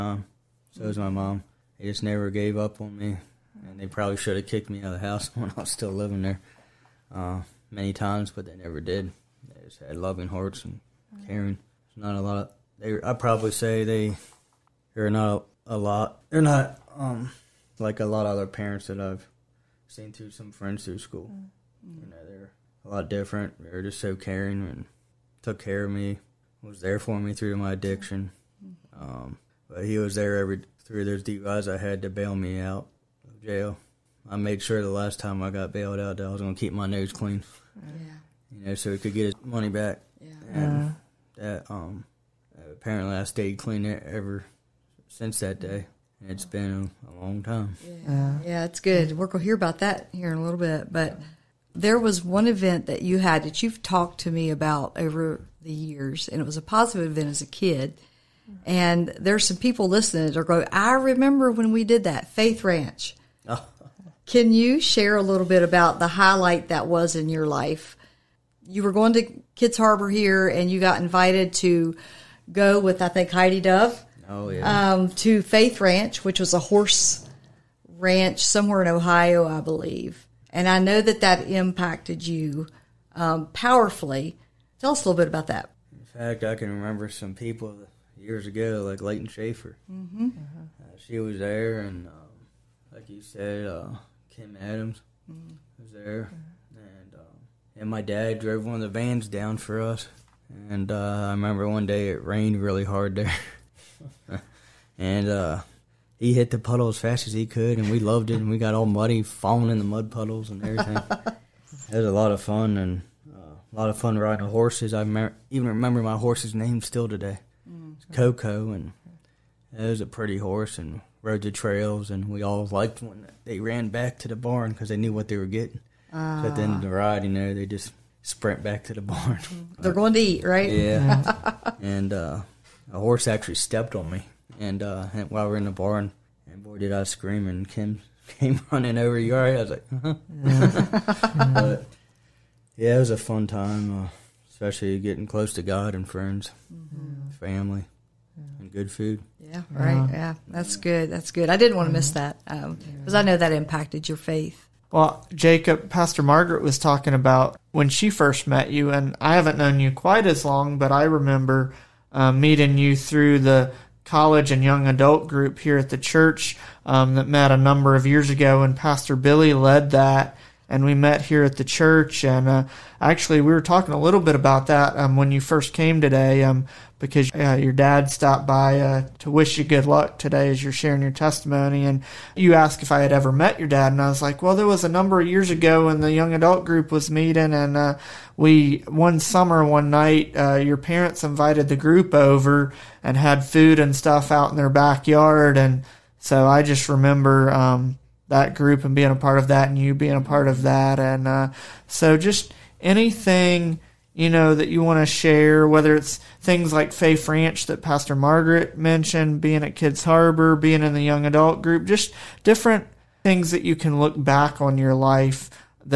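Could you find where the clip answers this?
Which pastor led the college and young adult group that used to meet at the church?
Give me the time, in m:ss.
2:48.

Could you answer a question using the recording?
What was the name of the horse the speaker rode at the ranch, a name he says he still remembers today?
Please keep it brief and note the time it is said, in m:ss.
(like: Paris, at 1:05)
Coco, at 1:58.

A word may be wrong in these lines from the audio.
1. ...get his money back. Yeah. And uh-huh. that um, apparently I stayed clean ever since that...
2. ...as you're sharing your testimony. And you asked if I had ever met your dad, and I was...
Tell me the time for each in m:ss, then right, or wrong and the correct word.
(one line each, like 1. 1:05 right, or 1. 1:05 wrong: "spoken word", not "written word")
1. 0:39 right
2. 3:00 right.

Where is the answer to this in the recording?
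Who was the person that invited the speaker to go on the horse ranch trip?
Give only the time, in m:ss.
1:13.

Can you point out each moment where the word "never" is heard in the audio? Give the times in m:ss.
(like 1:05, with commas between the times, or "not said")
0:02, 0:08.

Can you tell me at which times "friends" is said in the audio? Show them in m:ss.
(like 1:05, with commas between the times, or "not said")
0:20, 2:26.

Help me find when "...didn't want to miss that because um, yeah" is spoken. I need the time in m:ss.
2:31.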